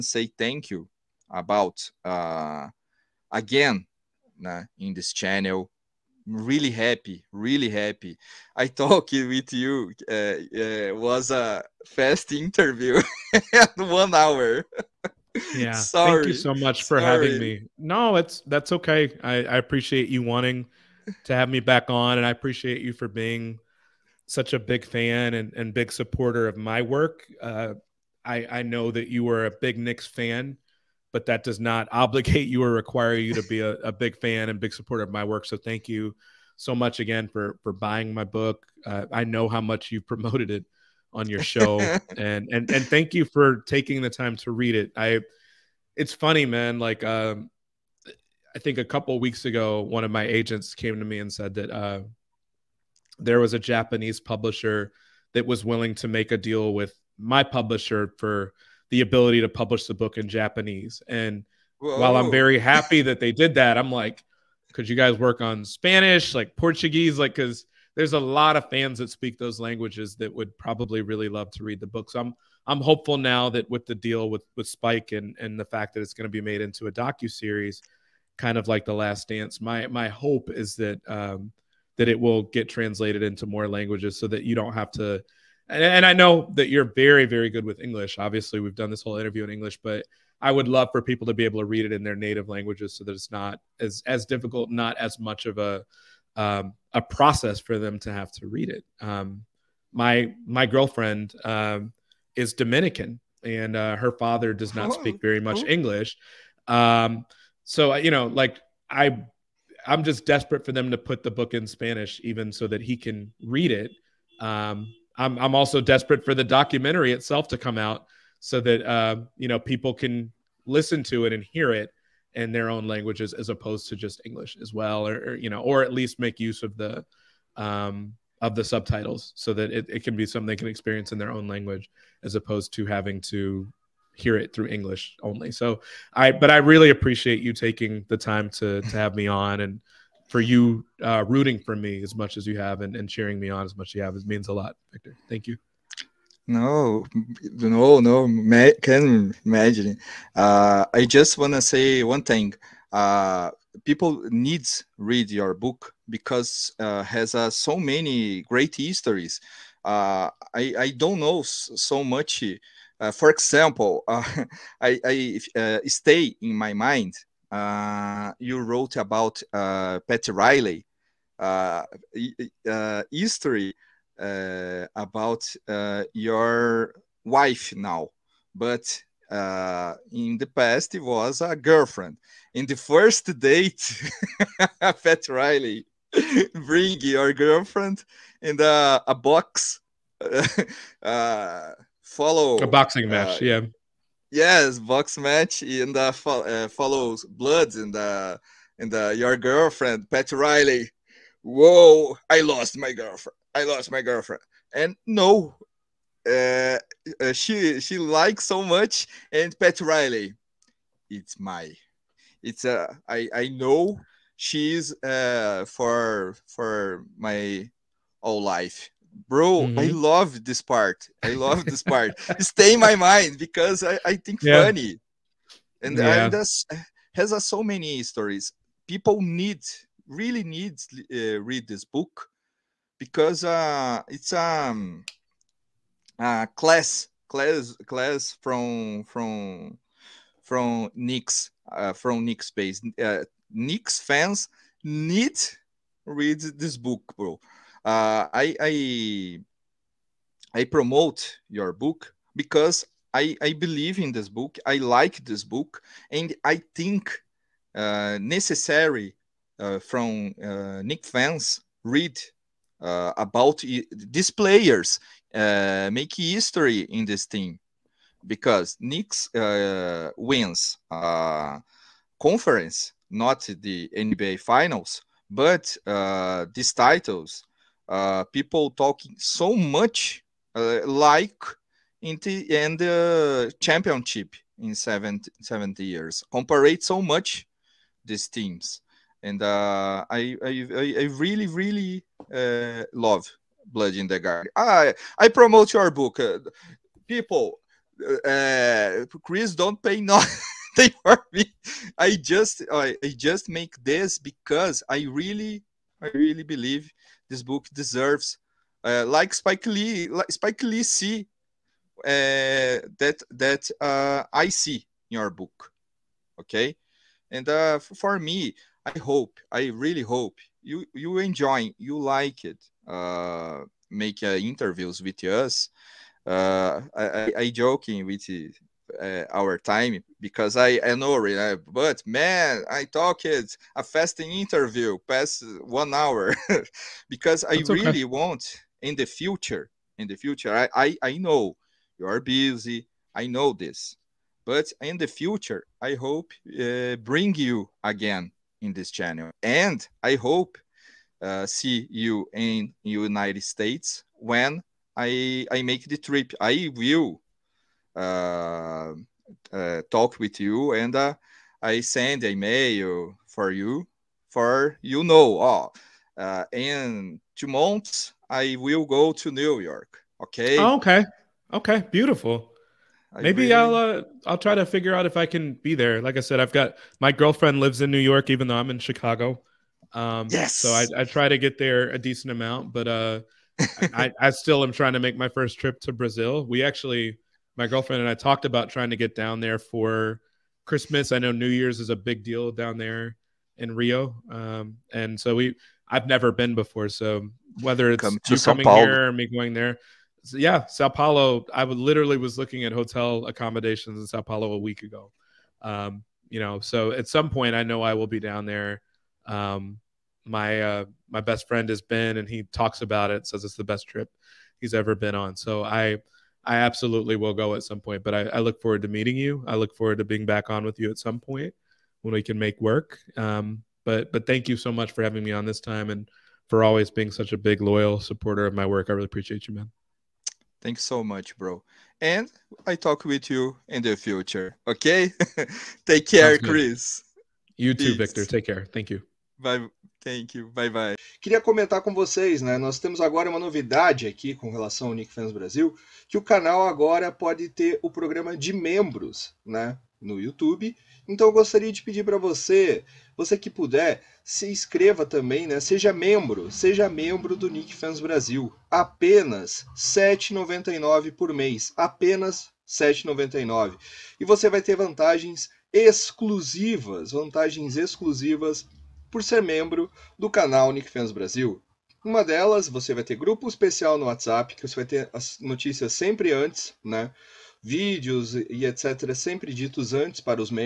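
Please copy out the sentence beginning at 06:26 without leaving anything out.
We actually, my girlfriend and I talked about trying to get down there for Christmas.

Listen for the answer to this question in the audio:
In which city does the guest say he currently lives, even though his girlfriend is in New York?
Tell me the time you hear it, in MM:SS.
06:18.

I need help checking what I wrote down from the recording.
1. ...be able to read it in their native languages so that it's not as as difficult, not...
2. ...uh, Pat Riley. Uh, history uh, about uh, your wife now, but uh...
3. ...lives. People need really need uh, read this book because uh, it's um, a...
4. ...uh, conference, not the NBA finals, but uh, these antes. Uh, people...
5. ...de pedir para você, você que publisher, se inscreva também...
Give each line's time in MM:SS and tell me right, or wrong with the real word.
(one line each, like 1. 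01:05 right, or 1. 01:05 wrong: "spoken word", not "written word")
1. 01:31 right
2. 02:49 right
3. 03:48 wrong: "stories", not "lives"
4. 04:30 wrong: "titles", not "antes"
5. 07:31 wrong: "puder", not "publisher".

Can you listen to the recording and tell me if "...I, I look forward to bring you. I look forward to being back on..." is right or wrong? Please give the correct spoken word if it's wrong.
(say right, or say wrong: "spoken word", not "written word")
wrong: "meeting", not "bring".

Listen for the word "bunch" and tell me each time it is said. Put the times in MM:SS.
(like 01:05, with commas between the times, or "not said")
not said.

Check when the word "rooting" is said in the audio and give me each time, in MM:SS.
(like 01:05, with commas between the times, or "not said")
02:21.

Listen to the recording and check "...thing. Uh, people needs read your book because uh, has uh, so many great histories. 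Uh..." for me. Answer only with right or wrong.
right.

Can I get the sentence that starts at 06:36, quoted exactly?
So whether it's Come you coming here or me going there, so yeah, Sao Paulo.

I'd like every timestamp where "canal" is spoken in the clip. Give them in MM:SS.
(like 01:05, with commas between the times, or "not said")
07:26, 07:50.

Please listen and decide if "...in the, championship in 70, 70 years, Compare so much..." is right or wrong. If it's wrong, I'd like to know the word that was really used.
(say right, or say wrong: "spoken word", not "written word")
right.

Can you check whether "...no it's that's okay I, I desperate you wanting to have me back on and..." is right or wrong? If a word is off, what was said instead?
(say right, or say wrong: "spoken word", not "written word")
wrong: "appreciate", not "desperate".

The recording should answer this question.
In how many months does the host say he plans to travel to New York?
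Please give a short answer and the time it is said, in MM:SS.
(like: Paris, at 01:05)
2, at 06:07.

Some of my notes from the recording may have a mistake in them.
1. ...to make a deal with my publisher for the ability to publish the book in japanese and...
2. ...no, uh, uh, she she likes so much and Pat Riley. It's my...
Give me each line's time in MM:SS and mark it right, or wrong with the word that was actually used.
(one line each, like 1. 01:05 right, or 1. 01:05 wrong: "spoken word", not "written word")
1. 00:55 right
2. 03:25 right.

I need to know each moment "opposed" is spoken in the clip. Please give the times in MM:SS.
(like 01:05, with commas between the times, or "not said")
02:03, 02:12.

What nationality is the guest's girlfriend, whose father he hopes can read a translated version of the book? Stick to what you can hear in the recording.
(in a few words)
Dominican.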